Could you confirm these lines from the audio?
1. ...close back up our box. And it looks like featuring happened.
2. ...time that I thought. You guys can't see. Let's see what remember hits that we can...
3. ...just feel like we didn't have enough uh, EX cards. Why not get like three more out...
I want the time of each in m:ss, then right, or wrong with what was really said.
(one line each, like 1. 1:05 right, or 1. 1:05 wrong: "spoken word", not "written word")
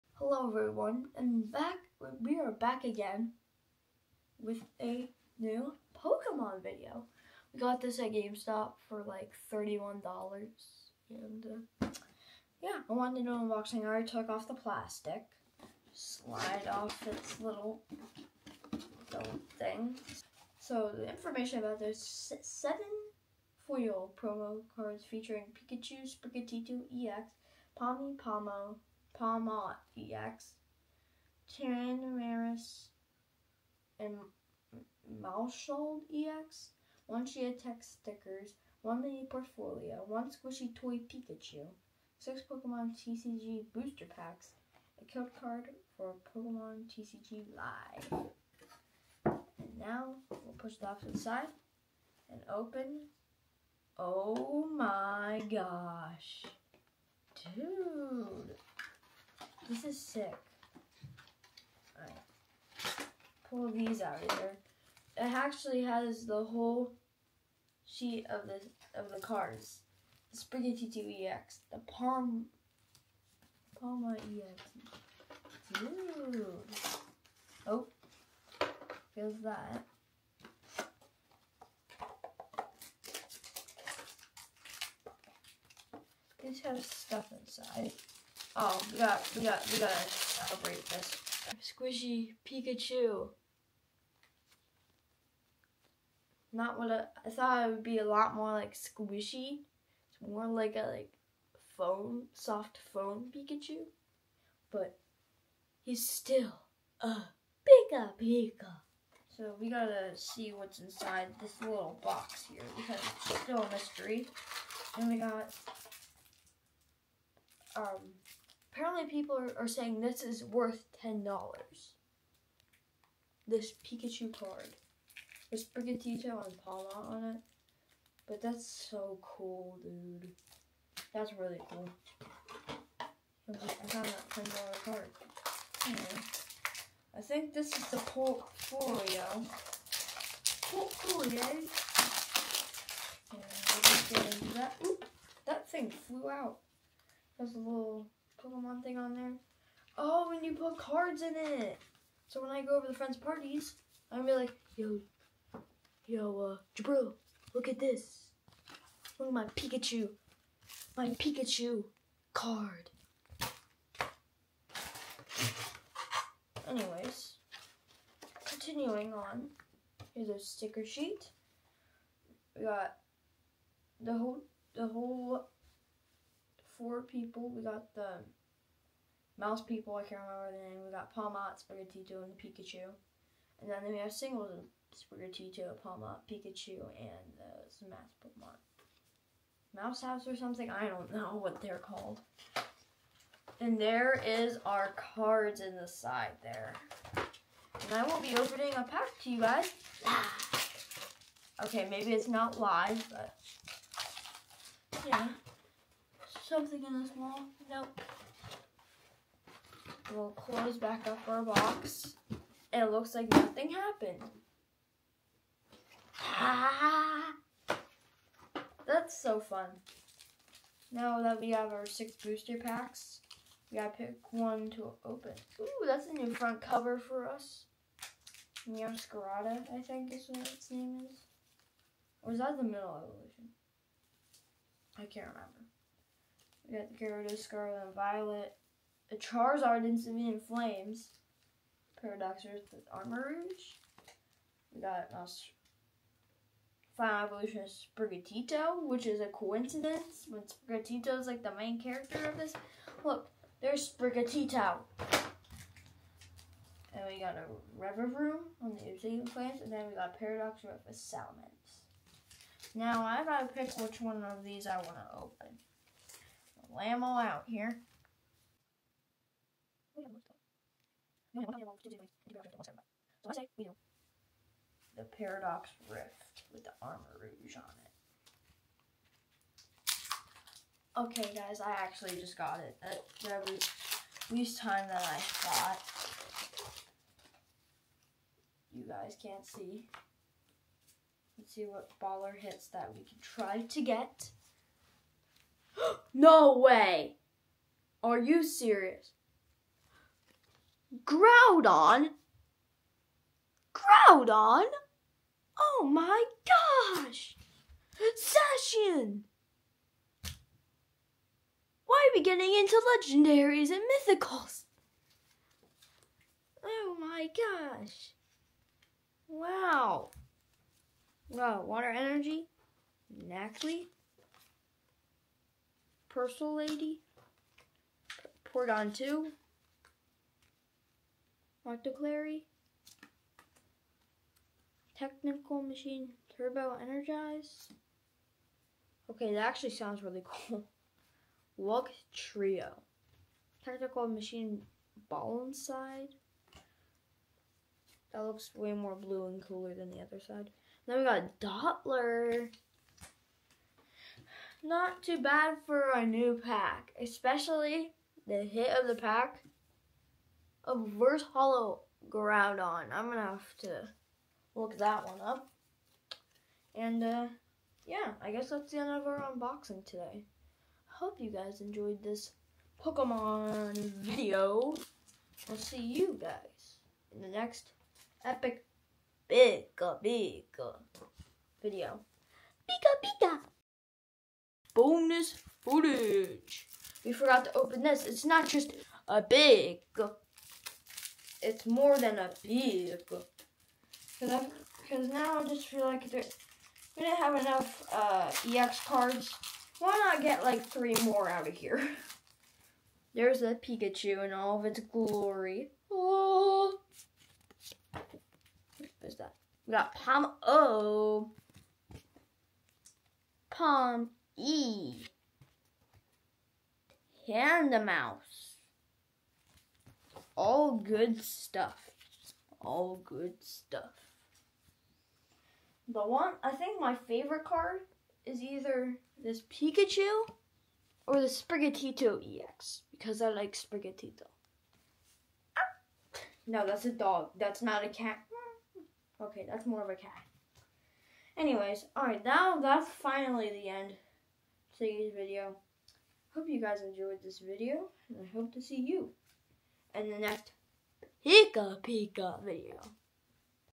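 1. 3:30 wrong: "nothing", not "featuring"
2. 4:44 wrong: "baller", not "remember"
3. 6:35 right.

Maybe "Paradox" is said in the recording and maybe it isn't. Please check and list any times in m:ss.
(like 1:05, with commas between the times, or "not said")
4:02, 4:20, 4:35.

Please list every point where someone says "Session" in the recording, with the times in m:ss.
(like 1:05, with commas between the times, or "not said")
5:08.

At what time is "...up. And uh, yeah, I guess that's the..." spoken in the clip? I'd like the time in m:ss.
6:05.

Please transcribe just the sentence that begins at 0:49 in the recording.
And now we'll push the off to the side and open.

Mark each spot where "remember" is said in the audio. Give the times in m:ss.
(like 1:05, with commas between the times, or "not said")
3:00, 3:55.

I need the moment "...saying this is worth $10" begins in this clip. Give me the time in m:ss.
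1:59.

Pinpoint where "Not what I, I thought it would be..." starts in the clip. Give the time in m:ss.
1:36.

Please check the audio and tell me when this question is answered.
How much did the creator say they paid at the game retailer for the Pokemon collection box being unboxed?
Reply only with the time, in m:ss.
0:09.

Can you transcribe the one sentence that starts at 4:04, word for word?
We got Final Evolution Sprigatito, which is a coincidence when Sprigatito is like the main character of this.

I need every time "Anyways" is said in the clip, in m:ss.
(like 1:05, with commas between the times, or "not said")
2:15, 2:46, 7:21.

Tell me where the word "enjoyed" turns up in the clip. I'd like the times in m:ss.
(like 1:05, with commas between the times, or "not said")
6:11, 7:26.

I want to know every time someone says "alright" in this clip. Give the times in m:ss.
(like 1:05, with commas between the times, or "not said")
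1:01, 7:21.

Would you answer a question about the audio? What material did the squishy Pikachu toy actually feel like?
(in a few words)
soft foam.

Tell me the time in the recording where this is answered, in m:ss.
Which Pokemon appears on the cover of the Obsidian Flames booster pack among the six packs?
4:17.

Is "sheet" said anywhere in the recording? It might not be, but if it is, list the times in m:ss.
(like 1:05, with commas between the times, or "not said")
1:07, 2:50.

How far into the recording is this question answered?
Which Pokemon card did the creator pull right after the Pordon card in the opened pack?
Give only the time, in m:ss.
5:31.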